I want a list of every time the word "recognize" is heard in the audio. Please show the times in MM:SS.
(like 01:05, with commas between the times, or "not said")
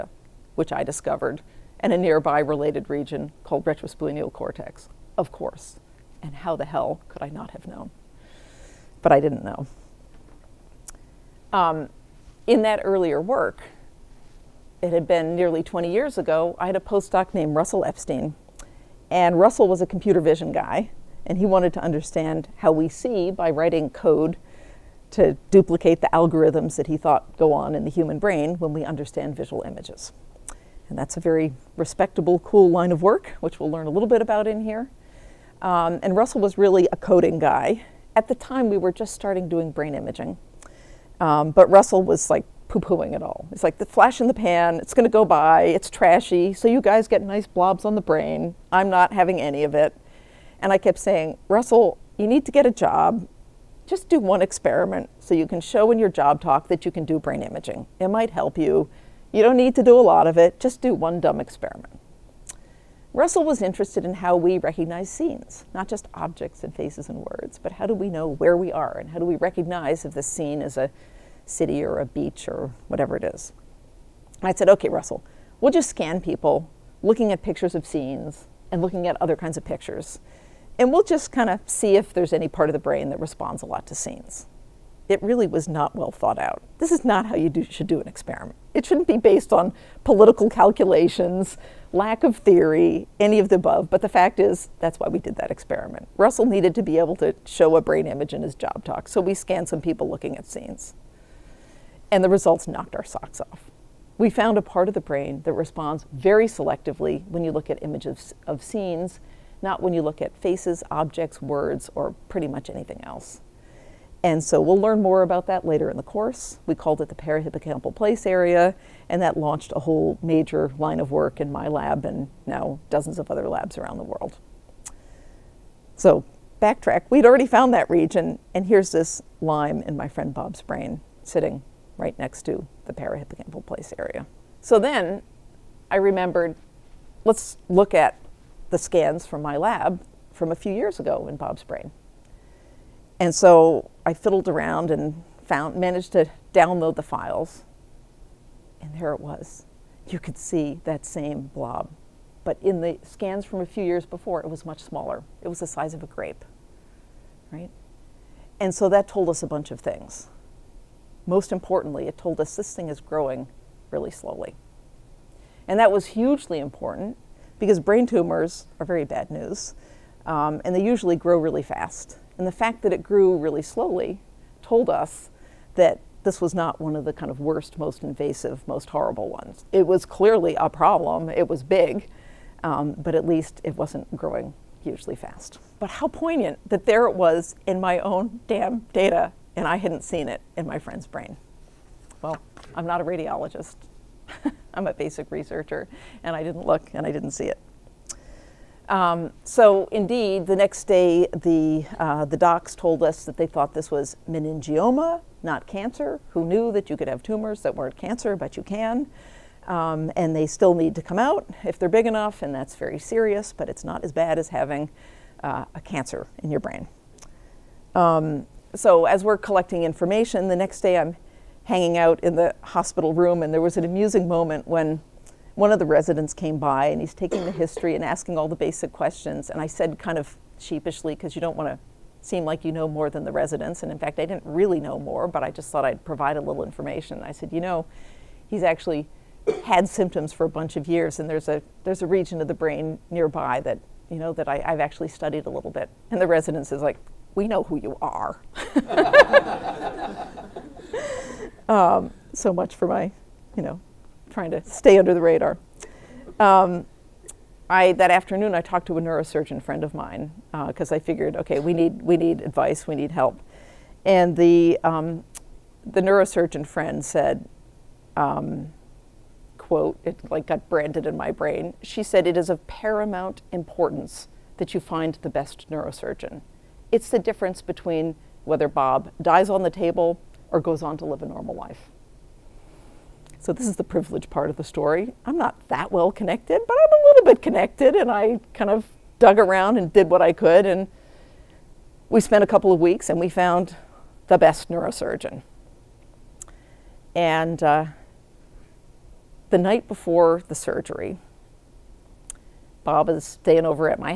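01:04, 01:09.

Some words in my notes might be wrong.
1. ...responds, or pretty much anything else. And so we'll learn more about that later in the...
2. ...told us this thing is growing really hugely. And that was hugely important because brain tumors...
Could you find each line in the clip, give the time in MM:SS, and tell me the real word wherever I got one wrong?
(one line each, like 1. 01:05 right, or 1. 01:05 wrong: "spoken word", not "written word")
1. 01:51 wrong: "words", not "responds"
2. 02:42 wrong: "slowly", not "hugely".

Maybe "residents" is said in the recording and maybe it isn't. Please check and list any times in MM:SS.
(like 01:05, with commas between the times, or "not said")
03:45, 03:53, 04:06.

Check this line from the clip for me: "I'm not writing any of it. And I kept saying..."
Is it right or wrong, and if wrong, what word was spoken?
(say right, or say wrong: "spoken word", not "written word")
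wrong: "having", not "writing".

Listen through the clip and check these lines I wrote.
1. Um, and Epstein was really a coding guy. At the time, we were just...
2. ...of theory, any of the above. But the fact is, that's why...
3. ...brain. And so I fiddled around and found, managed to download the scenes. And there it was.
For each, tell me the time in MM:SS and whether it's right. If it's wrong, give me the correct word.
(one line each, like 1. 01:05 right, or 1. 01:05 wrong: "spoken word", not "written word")
1. 00:35 wrong: "Russell", not "Epstein"
2. 01:32 right
3. 02:21 wrong: "files", not "scenes".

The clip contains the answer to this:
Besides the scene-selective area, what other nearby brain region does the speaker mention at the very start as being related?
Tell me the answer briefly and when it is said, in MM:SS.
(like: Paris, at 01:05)
Retrosplenial cortex, at 00:03.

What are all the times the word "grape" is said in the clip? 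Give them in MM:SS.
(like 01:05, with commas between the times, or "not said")
02:36.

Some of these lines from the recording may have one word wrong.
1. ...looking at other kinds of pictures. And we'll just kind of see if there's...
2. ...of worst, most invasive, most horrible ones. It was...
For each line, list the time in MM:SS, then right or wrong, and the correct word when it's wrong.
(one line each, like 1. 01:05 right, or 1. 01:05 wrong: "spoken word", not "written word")
1. 01:18 right
2. 02:57 right.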